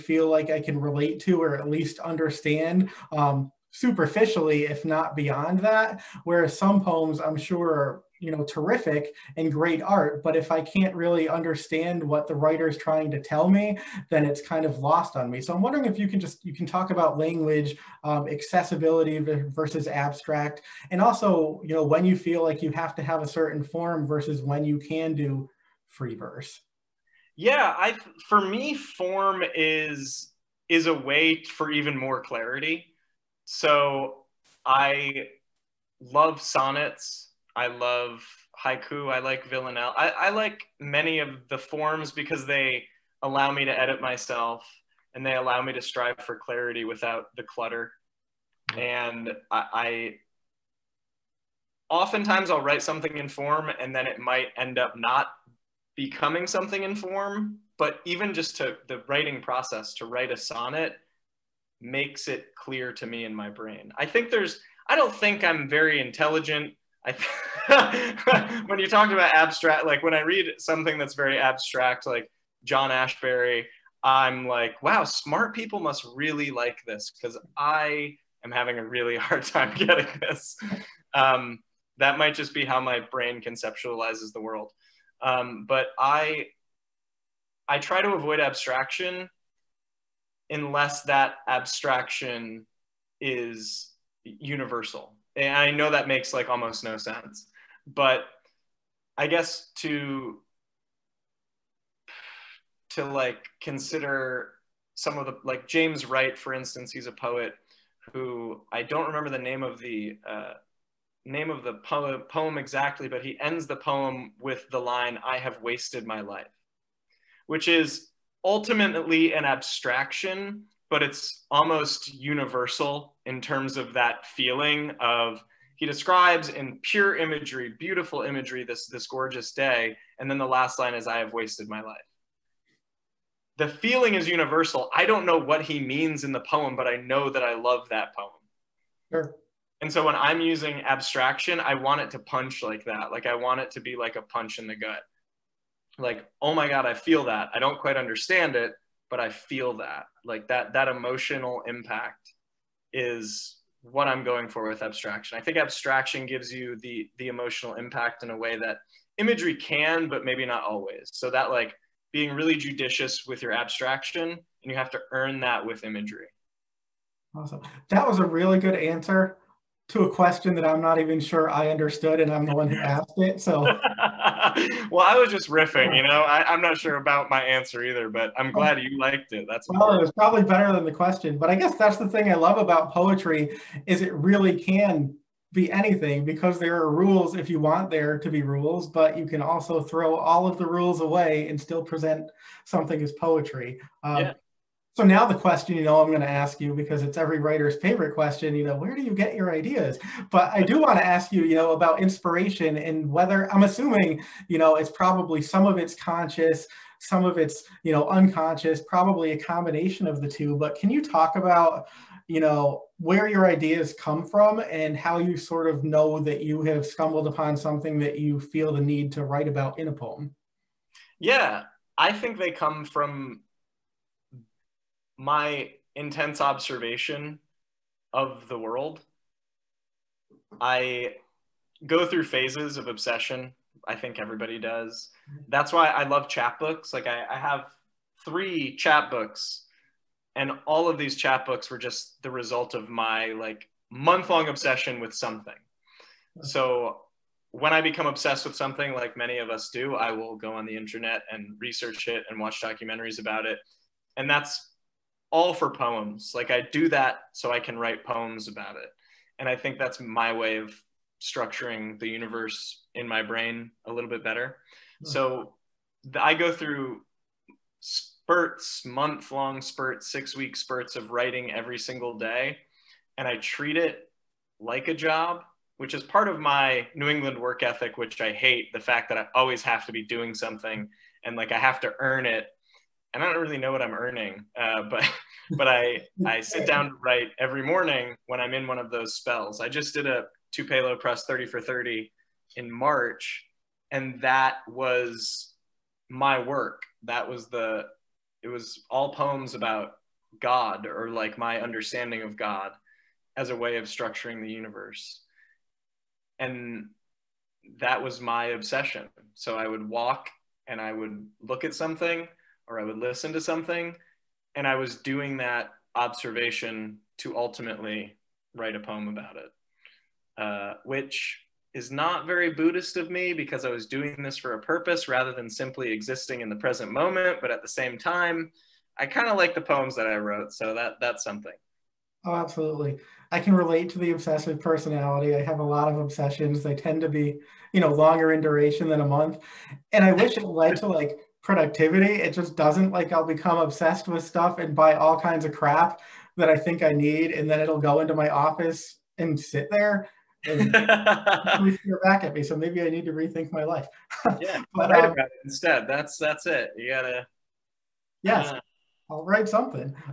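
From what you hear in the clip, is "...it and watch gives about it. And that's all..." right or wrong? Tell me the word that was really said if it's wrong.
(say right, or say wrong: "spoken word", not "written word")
wrong: "documentaries", not "gives".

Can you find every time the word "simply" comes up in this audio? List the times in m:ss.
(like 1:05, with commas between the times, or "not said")
5:25.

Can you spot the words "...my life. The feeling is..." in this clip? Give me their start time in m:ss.
2:11.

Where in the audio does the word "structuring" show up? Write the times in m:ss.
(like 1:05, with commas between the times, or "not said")
4:21, 5:03.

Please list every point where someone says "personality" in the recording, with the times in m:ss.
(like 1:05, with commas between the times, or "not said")
5:34.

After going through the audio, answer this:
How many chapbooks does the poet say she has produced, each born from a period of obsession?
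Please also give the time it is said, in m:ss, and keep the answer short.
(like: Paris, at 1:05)
3, at 3:58.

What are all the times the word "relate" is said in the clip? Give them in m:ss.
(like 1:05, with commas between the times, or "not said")
0:00, 5:33.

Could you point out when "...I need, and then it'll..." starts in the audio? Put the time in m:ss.
5:46.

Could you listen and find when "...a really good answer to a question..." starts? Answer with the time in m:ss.
2:48.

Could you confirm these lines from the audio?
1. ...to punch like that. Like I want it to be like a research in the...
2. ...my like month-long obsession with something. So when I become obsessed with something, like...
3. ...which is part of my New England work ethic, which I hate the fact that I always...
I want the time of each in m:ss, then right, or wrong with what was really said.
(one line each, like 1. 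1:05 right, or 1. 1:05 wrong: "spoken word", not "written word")
1. 2:22 wrong: "punch", not "research"
2. 4:02 right
3. 4:35 right.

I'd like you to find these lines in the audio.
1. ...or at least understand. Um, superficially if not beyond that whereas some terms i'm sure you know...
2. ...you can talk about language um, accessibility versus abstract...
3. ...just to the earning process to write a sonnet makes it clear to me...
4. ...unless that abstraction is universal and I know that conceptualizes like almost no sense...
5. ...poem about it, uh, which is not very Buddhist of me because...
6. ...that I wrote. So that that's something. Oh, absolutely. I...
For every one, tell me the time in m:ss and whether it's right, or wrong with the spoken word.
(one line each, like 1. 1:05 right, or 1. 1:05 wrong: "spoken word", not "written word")
1. 0:01 wrong: "poems", not "terms"
2. 0:16 right
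3. 0:58 wrong: "writing", not "earning"
4. 1:30 wrong: "makes", not "conceptualizes"
5. 5:18 right
6. 5:29 right.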